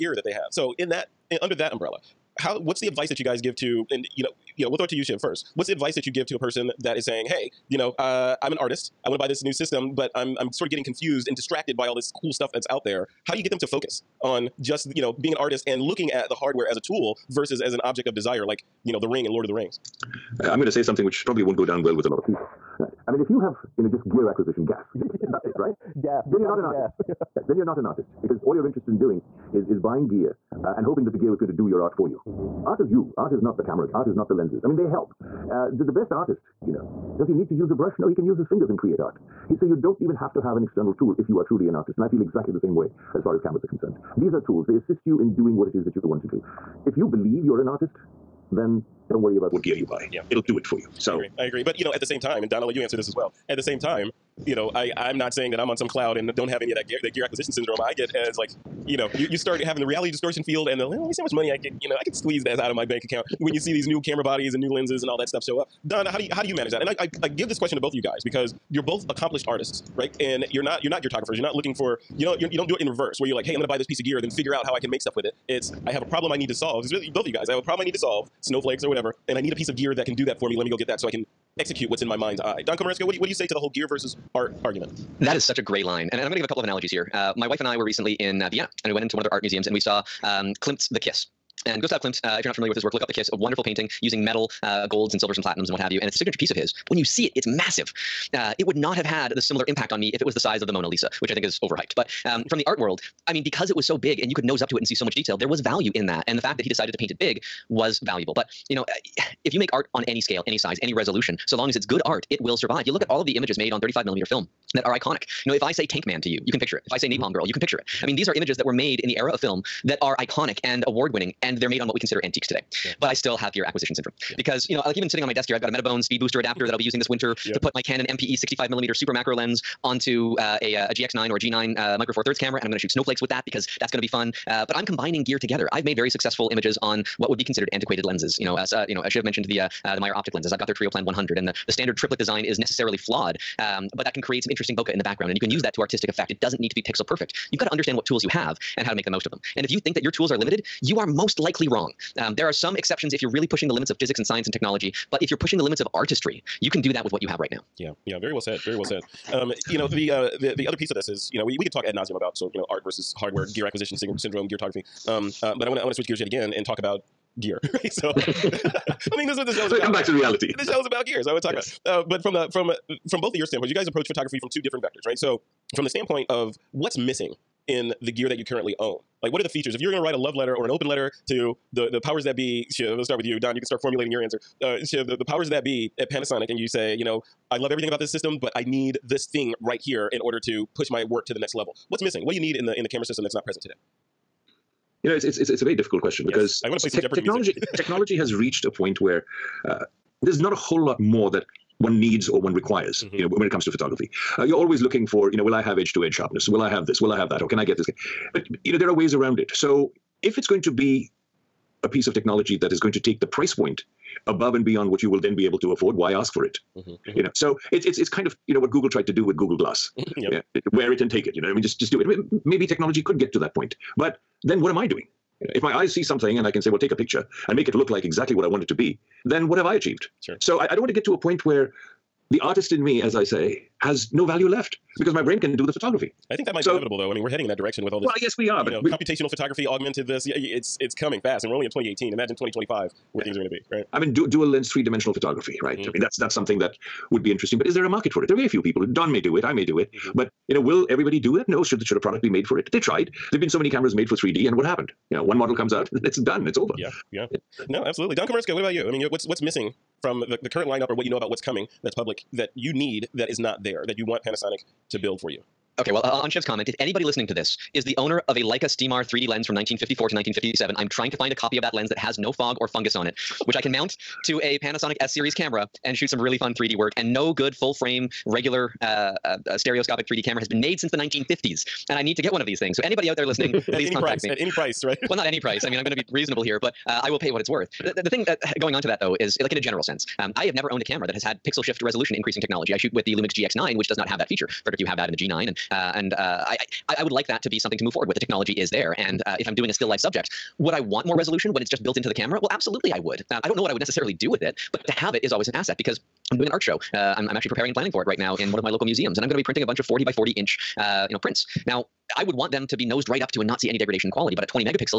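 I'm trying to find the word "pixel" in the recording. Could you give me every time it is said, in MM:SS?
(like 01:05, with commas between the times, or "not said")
02:26, 04:51.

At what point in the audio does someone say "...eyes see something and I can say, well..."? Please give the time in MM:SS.
03:45.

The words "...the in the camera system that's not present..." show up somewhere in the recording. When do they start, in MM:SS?
03:12.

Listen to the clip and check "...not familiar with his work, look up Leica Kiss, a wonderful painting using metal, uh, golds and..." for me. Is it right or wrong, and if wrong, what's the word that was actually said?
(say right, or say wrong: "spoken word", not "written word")
wrong: "The", not "Leica".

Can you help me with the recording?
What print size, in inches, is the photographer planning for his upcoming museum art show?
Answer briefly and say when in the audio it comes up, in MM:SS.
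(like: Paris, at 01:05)
40 by 40 inches, at 05:09.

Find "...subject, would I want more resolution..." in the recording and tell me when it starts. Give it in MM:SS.
04:59.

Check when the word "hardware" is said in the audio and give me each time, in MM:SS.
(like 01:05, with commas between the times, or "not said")
00:16, 02:43.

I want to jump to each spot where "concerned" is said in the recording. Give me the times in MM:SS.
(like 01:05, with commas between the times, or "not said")
00:43.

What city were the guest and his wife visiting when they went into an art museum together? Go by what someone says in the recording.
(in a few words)
Vienna.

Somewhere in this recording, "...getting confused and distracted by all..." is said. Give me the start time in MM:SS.
00:10.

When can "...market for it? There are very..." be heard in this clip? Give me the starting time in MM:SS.
04:07.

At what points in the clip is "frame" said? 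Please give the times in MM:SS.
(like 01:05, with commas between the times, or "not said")
04:37.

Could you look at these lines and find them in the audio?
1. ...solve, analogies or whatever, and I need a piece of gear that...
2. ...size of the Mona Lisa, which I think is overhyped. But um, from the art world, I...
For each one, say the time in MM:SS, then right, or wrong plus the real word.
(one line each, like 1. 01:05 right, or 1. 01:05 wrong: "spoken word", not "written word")
1. 01:17 wrong: "snowflakes", not "analogies"
2. 01:40 right.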